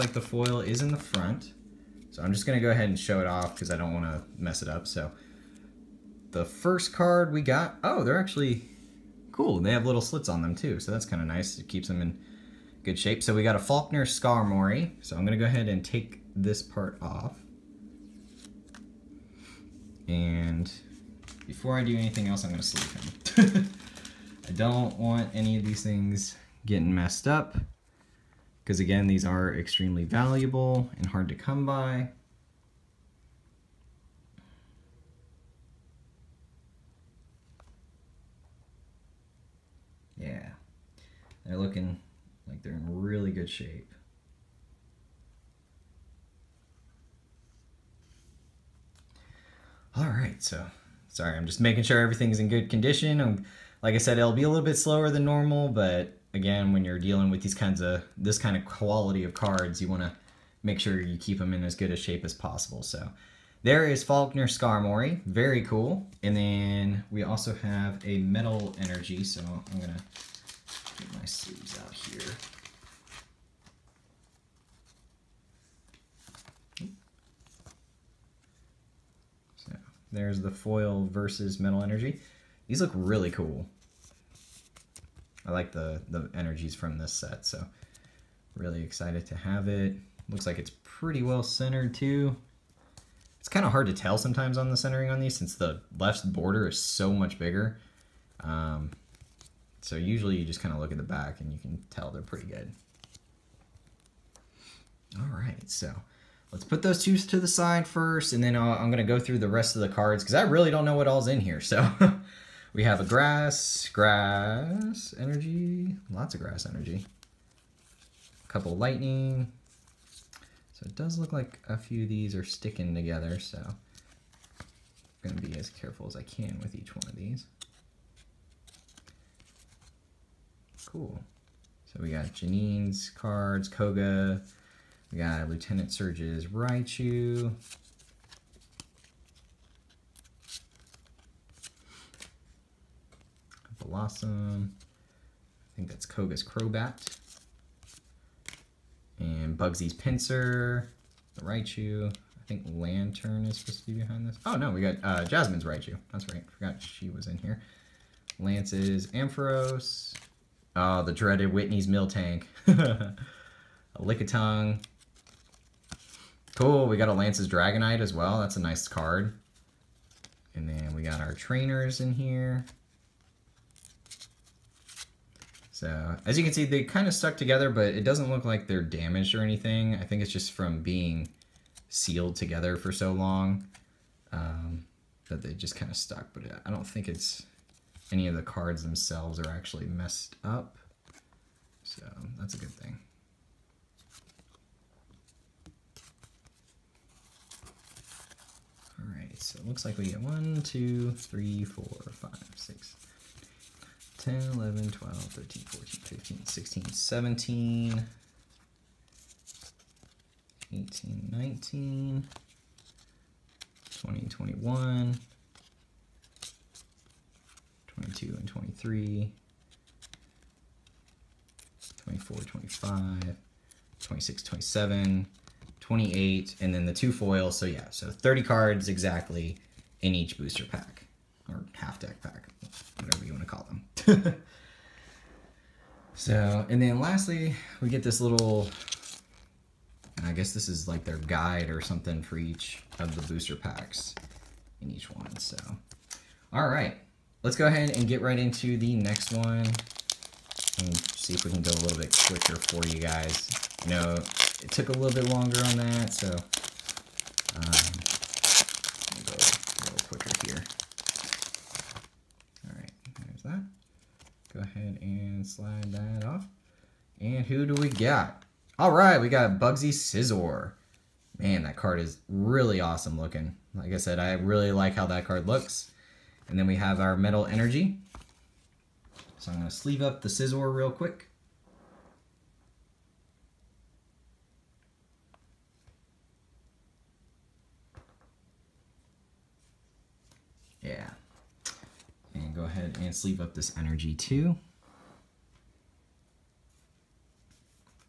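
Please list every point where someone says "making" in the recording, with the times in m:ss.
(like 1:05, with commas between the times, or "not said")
0:51.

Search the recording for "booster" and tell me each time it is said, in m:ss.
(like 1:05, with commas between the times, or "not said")
3:50, 4:03.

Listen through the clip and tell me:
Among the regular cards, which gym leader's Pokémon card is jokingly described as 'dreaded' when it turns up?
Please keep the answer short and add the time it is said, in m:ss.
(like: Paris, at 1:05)
Whitney's Miltank, at 2:41.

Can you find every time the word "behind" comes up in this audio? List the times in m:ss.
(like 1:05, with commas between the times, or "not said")
2:33.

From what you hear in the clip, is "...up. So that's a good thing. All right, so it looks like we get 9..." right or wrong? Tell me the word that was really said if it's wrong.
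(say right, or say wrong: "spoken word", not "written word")
wrong: "1", not "9".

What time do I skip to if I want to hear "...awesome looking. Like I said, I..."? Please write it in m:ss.
4:32.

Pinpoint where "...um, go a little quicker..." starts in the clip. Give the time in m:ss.
4:16.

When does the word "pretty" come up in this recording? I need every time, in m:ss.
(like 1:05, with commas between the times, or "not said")
1:30, 1:42.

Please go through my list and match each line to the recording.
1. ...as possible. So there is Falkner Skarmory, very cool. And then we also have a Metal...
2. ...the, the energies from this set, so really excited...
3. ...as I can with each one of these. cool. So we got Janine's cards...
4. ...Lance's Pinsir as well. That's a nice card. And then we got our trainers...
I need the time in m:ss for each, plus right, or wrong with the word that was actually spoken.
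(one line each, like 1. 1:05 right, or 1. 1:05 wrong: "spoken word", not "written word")
1. 1:02 right
2. 1:25 right
3. 2:06 right
4. 2:47 wrong: "Dragonite", not "Pinsir".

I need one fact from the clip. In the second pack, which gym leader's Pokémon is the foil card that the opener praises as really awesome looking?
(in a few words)
Bugsy's Scizor.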